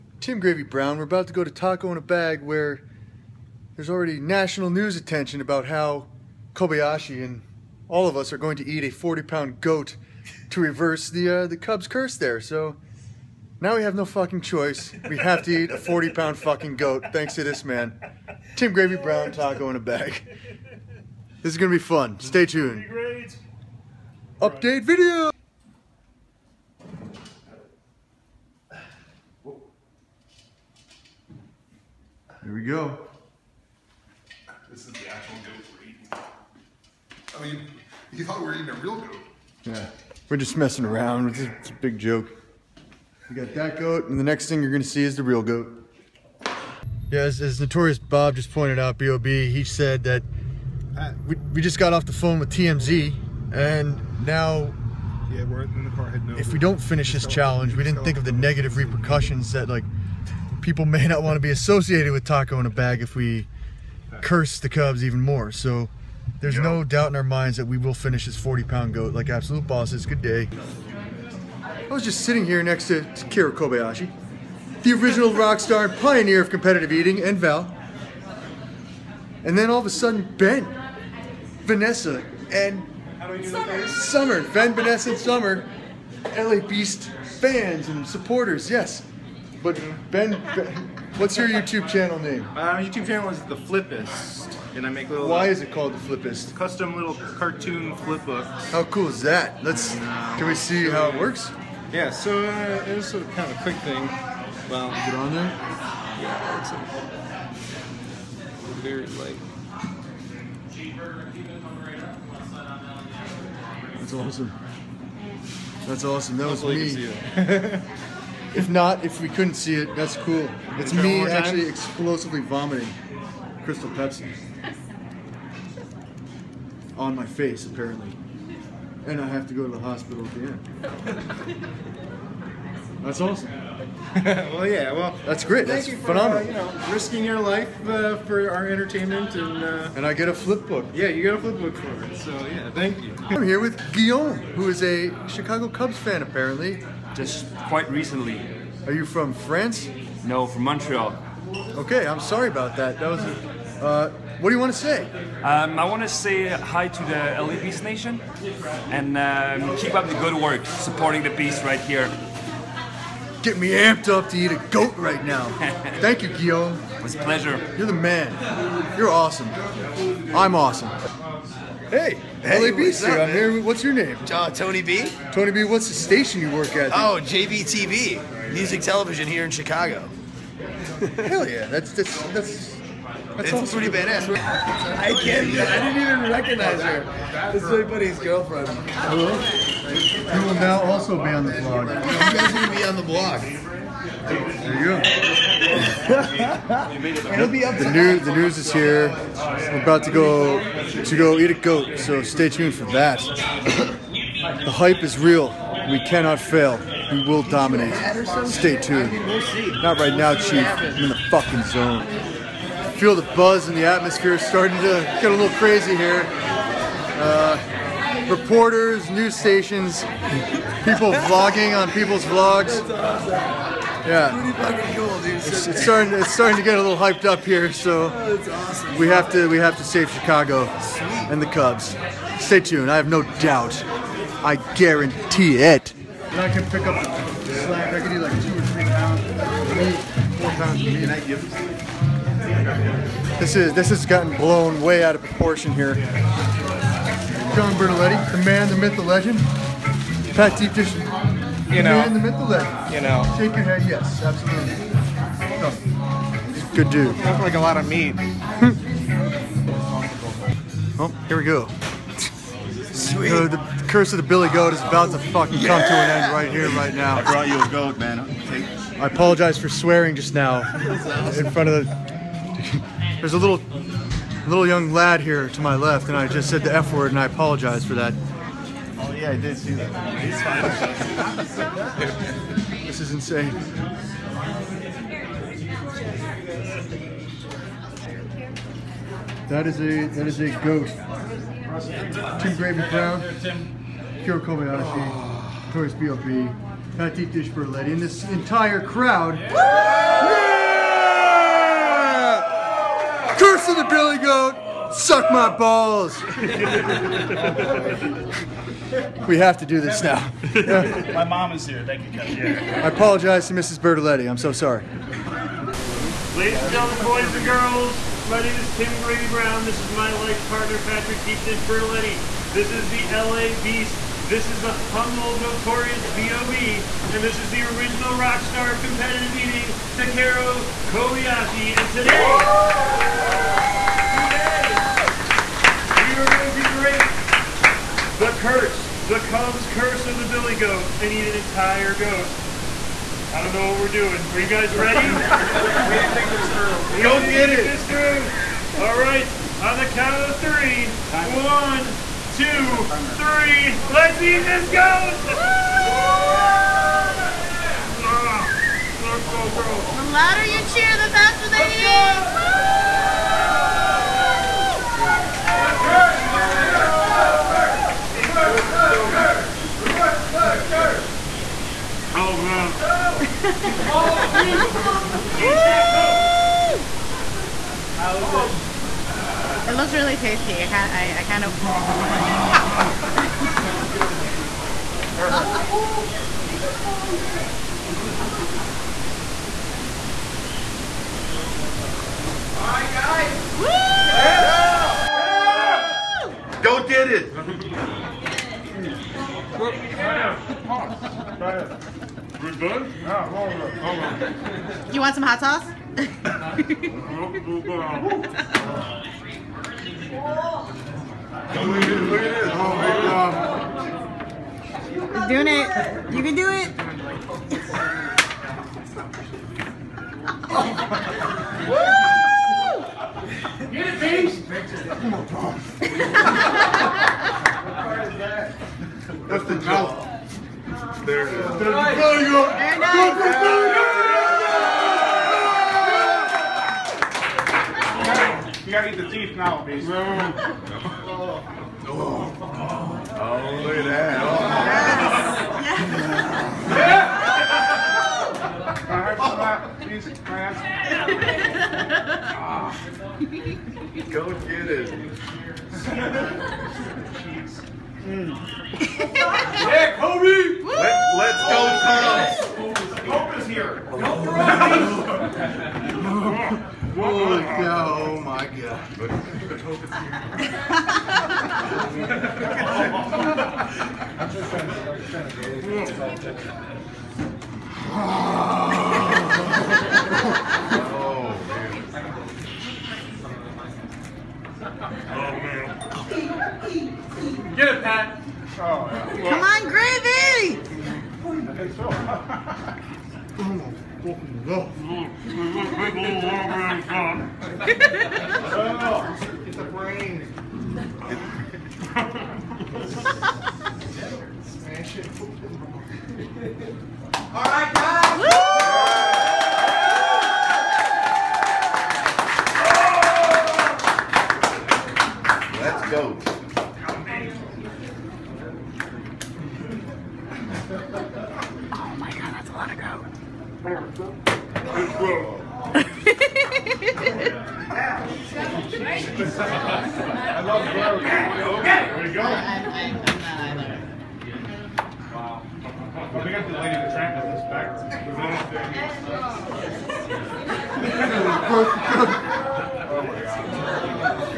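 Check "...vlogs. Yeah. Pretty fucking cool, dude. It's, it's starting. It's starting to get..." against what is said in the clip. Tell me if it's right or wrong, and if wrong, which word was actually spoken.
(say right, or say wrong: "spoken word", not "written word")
right.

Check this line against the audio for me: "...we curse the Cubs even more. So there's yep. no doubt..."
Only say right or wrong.
right.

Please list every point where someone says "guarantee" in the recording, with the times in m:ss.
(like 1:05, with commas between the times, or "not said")
3:54.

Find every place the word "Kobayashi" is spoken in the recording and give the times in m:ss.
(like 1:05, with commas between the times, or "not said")
0:06, 1:13, 4:54, 5:30.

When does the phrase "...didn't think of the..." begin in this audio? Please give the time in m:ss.
0:57.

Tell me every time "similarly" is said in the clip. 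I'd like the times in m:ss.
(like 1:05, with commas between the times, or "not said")
not said.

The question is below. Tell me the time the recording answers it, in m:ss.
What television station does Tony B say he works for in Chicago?
2:57.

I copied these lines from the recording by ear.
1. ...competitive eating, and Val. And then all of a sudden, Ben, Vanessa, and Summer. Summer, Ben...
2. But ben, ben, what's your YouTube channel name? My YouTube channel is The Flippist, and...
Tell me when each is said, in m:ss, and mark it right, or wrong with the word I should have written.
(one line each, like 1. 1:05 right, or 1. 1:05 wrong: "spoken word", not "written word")
1. 1:16 right
2. 1:29 right.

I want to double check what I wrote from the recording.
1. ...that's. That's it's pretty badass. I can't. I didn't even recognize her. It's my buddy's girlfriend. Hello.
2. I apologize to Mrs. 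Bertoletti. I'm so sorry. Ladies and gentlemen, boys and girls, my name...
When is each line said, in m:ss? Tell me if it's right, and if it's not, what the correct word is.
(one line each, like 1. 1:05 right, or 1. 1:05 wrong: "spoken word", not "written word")
1. 3:02 right
2. 5:12 right.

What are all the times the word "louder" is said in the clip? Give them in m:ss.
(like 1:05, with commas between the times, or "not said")
6:00.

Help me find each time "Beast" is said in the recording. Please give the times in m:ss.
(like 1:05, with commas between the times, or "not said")
1:26, 2:37, 5:23, 7:03.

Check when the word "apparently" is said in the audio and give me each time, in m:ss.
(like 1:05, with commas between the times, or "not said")
2:07, 2:26.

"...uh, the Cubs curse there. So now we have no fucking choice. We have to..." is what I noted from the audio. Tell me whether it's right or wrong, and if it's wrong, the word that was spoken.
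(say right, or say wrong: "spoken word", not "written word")
right.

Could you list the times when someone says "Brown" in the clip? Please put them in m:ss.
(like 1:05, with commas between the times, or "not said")
0:00, 0:18, 4:52, 5:19.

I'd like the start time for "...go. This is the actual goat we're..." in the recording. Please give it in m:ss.
0:32.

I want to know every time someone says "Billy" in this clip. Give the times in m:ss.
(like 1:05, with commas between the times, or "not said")
4:24, 5:03, 5:40.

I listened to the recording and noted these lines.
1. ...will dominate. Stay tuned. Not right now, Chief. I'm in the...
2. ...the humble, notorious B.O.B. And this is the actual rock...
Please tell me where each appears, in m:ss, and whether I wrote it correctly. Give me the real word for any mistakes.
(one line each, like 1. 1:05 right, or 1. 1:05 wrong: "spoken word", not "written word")
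1. 3:27 right
2. 5:24 wrong: "original", not "actual".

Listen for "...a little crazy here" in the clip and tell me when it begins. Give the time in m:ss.
3:35.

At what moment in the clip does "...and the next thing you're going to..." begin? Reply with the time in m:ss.
0:44.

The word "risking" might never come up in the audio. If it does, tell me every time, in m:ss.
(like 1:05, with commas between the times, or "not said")
2:16.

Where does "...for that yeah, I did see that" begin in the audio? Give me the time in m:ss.
4:37.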